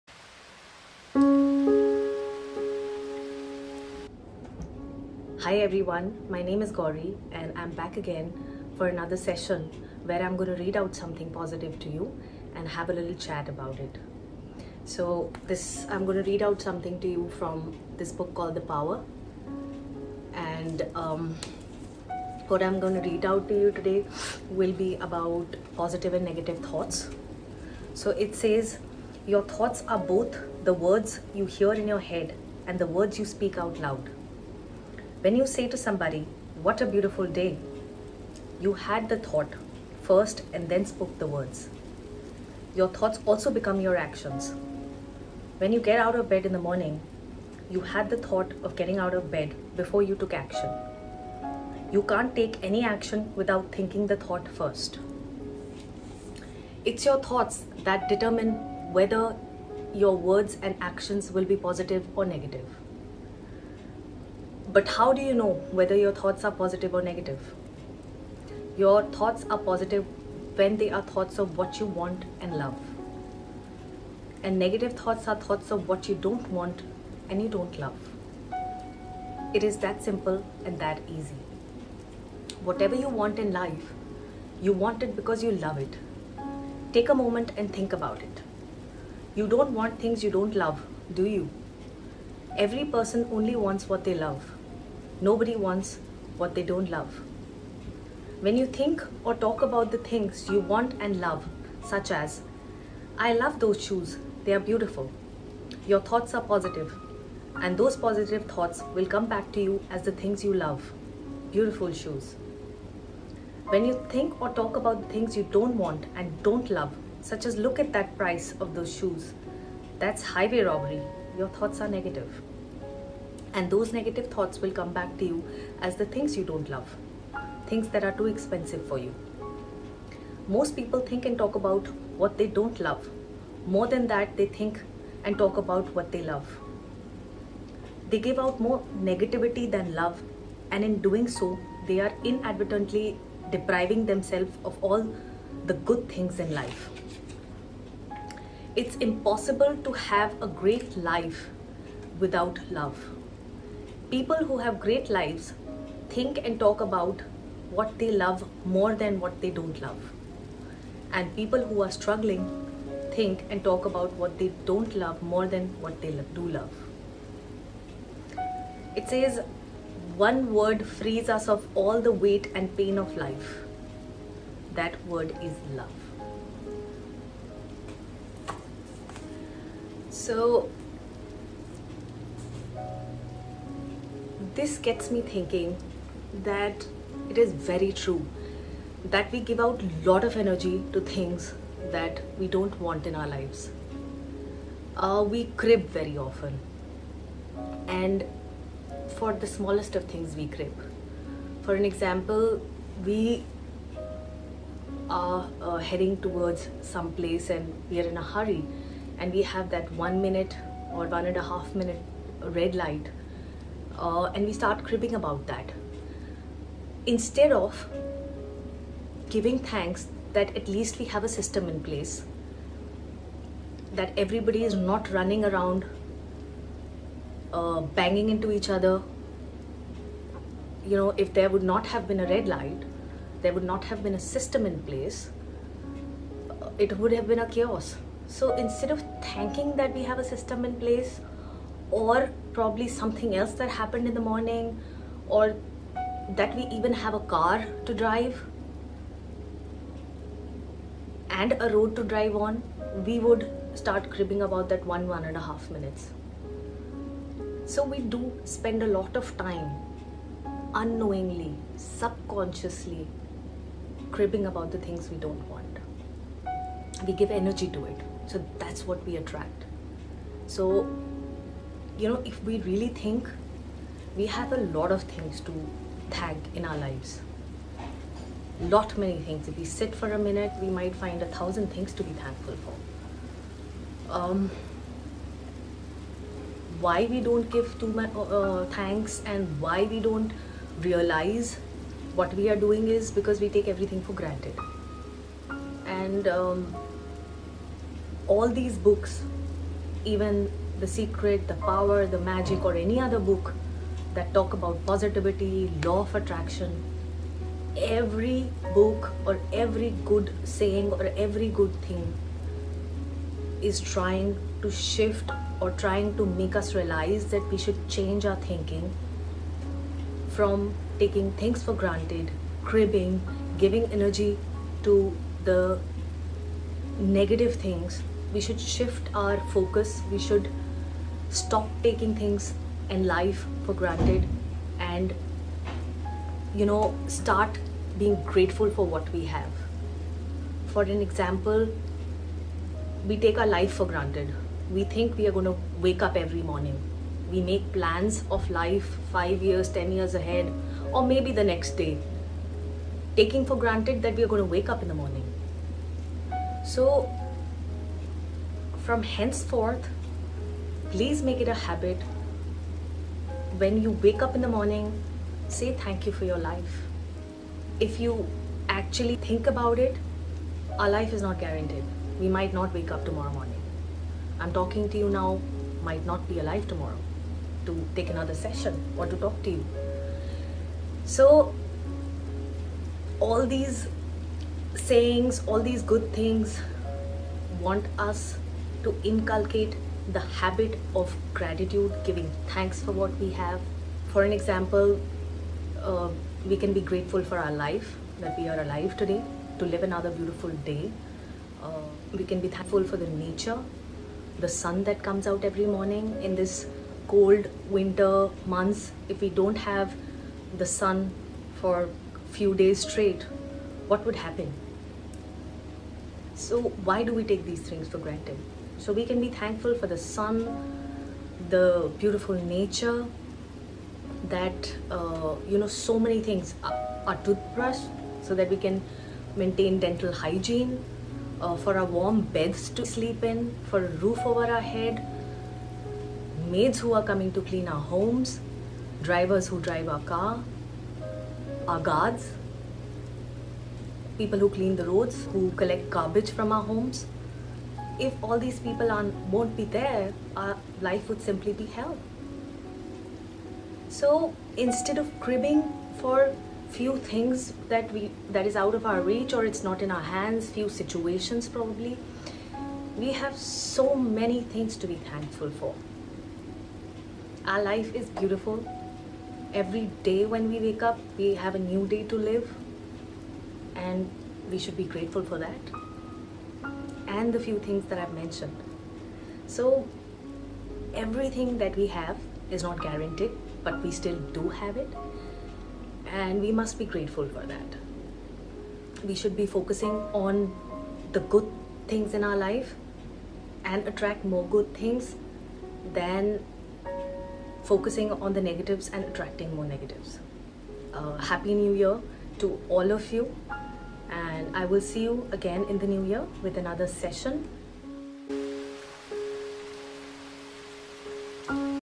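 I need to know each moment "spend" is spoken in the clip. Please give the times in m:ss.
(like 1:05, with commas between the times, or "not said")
4:18.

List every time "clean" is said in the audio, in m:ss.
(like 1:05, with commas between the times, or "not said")
7:17, 7:24.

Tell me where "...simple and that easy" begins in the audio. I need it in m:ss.
1:20.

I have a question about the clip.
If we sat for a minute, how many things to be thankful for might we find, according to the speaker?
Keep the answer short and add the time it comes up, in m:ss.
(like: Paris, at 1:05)
1000, at 4:41.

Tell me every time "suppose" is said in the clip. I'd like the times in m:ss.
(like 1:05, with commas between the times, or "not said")
not said.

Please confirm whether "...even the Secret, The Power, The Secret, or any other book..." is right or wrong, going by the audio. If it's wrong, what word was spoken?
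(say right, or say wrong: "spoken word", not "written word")
wrong: "Magic", not "Secret".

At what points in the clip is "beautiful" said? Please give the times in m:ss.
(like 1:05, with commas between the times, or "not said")
0:36, 1:44, 1:51, 6:40, 7:01, 7:48.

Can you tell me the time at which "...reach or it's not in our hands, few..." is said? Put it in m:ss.
7:39.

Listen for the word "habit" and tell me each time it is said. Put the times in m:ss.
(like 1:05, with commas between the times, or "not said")
6:01, 6:30.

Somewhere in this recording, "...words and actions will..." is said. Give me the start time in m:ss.
1:00.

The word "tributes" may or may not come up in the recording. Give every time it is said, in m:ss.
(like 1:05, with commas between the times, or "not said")
not said.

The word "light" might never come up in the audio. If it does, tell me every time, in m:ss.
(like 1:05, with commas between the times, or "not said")
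3:32, 3:52.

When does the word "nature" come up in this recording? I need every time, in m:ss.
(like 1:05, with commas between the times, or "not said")
6:43, 7:02.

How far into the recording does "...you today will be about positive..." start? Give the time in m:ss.
0:23.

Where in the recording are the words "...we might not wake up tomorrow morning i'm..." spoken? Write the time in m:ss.
6:12.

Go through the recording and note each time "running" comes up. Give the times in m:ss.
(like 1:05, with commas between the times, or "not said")
3:45.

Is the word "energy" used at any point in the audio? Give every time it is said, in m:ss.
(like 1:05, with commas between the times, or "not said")
3:10, 4:27, 5:23.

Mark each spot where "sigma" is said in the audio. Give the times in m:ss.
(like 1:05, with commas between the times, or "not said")
not said.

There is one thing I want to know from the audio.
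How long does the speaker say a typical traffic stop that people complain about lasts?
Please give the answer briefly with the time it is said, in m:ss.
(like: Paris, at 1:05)
1 or 1.5 minutes, at 3:29.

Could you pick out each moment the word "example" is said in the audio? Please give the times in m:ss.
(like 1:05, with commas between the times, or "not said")
3:21, 5:41, 6:34.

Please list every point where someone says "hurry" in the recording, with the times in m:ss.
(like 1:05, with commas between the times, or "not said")
3:28.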